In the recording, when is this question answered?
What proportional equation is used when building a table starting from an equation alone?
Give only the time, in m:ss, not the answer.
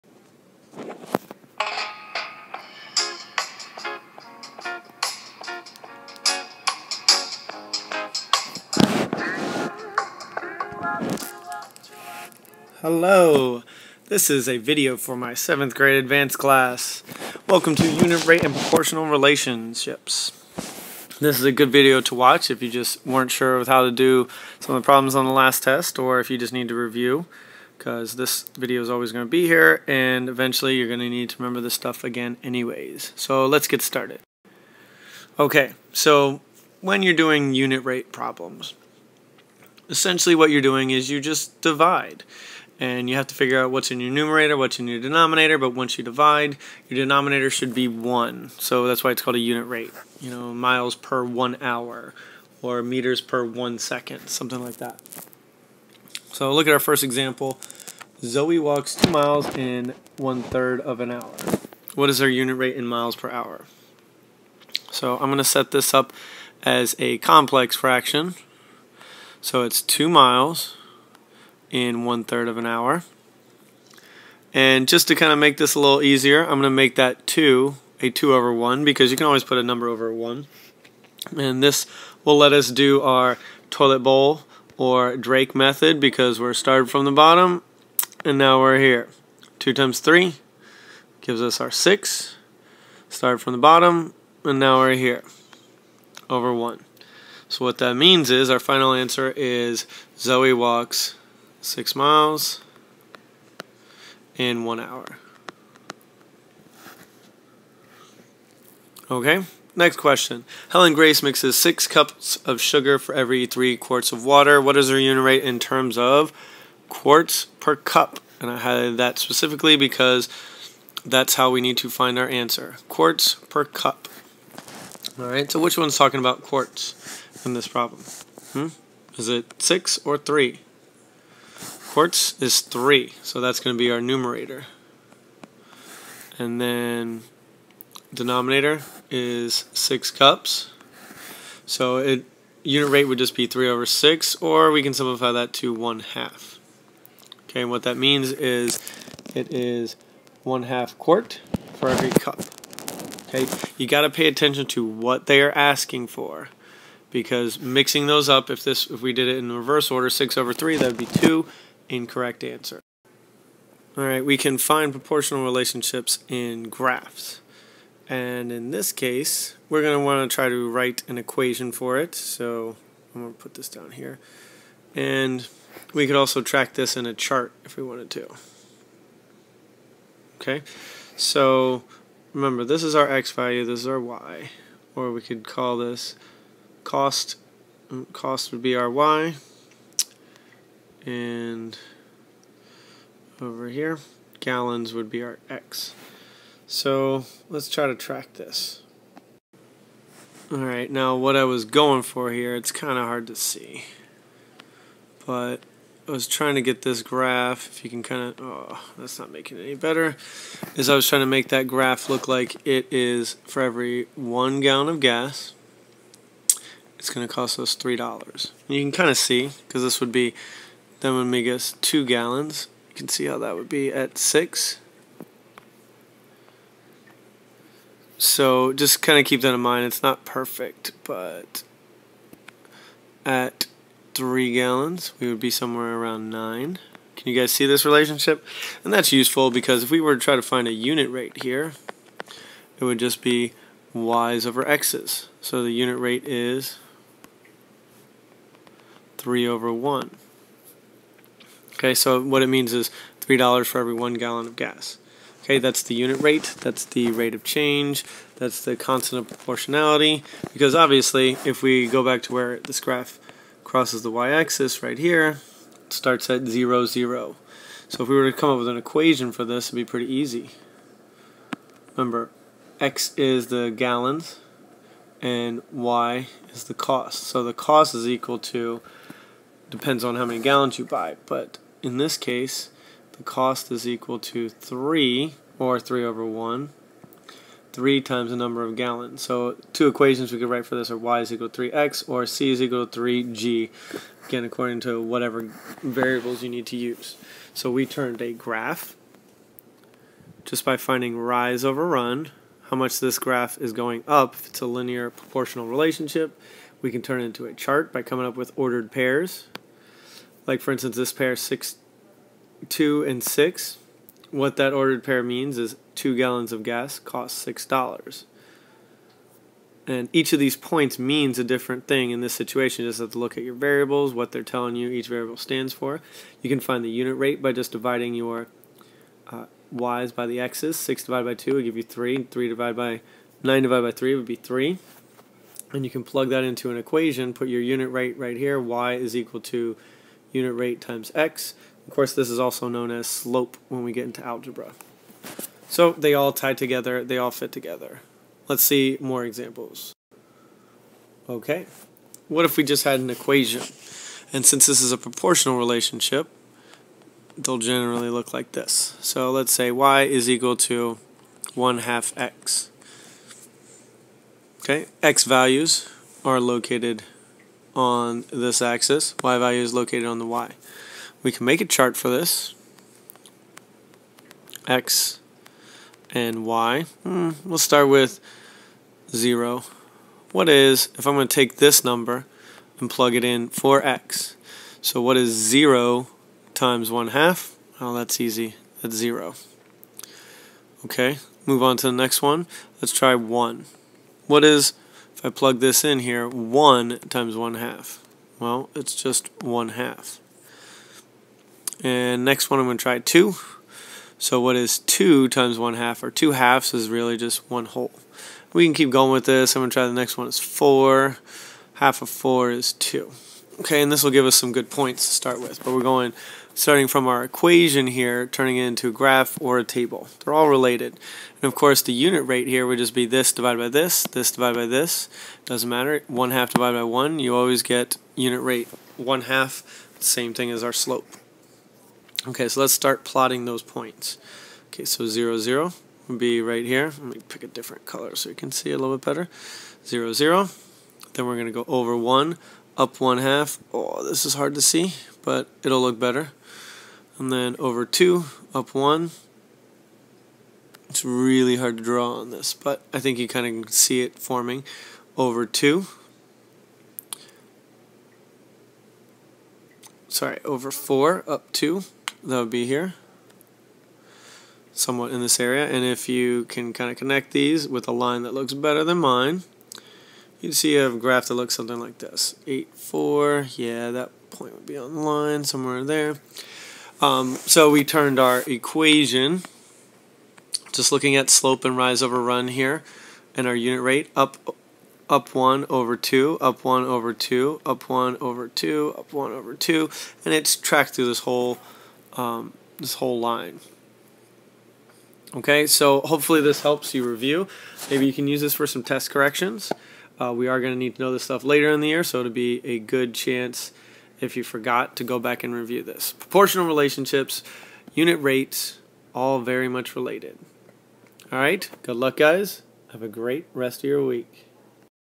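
5:59.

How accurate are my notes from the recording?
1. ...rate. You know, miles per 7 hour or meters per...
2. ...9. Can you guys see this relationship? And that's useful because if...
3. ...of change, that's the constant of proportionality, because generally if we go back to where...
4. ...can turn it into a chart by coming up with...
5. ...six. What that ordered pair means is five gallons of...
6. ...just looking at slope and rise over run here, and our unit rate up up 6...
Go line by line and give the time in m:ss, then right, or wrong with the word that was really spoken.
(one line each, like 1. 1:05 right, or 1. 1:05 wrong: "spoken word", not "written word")
1. 0:49 wrong: "1", not "7"
2. 3:56 right
3. 4:17 wrong: "obviously", not "generally"
4. 5:06 right
5. 5:13 wrong: "two", not "five"
6. 8:00 wrong: "1", not "6".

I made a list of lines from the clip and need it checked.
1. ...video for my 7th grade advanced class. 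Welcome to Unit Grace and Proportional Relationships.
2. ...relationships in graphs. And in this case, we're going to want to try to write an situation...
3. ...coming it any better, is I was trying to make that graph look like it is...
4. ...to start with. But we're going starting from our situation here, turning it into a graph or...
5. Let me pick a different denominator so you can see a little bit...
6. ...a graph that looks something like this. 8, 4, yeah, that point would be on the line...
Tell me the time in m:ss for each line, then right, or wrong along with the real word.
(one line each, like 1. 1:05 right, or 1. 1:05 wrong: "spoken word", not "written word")
1. 0:14 wrong: "Rate", not "Grace"
2. 2:45 wrong: "equation", not "situation"
3. 3:29 wrong: "making", not "coming"
4. 6:55 wrong: "equation", not "situation"
5. 7:16 wrong: "color", not "denominator"
6. 7:50 right.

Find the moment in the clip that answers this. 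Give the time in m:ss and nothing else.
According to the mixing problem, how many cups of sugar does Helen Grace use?
1:51.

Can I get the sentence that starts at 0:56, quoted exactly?
So look at our first example.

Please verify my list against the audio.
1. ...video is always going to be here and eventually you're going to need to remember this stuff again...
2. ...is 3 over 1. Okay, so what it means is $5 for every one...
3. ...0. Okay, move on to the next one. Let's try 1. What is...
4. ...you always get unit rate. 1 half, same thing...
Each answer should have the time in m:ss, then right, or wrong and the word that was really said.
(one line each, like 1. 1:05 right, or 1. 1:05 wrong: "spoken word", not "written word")
1. 0:28 right
2. 4:06 wrong: "3", not "5"
3. 6:28 right
4. 7:07 right.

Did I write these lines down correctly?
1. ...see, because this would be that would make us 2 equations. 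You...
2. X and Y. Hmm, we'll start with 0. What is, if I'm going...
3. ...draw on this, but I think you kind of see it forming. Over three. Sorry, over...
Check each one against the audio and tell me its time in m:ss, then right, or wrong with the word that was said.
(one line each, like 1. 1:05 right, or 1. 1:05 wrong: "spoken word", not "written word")
1. 3:39 wrong: "gallons", not "equations"
2. 6:14 right
3. 7:31 wrong: "two", not "three".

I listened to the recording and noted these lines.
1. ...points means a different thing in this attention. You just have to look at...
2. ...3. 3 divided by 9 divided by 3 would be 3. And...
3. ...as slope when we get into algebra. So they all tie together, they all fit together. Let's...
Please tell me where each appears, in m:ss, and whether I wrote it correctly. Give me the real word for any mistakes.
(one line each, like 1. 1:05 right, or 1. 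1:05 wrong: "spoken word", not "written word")
1. 5:20 wrong: "situation", not "attention"
2. 5:31 right
3. 5:42 right.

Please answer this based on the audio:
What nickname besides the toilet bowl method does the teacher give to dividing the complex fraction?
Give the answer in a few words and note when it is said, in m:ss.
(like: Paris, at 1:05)
Drake method, at 1:25.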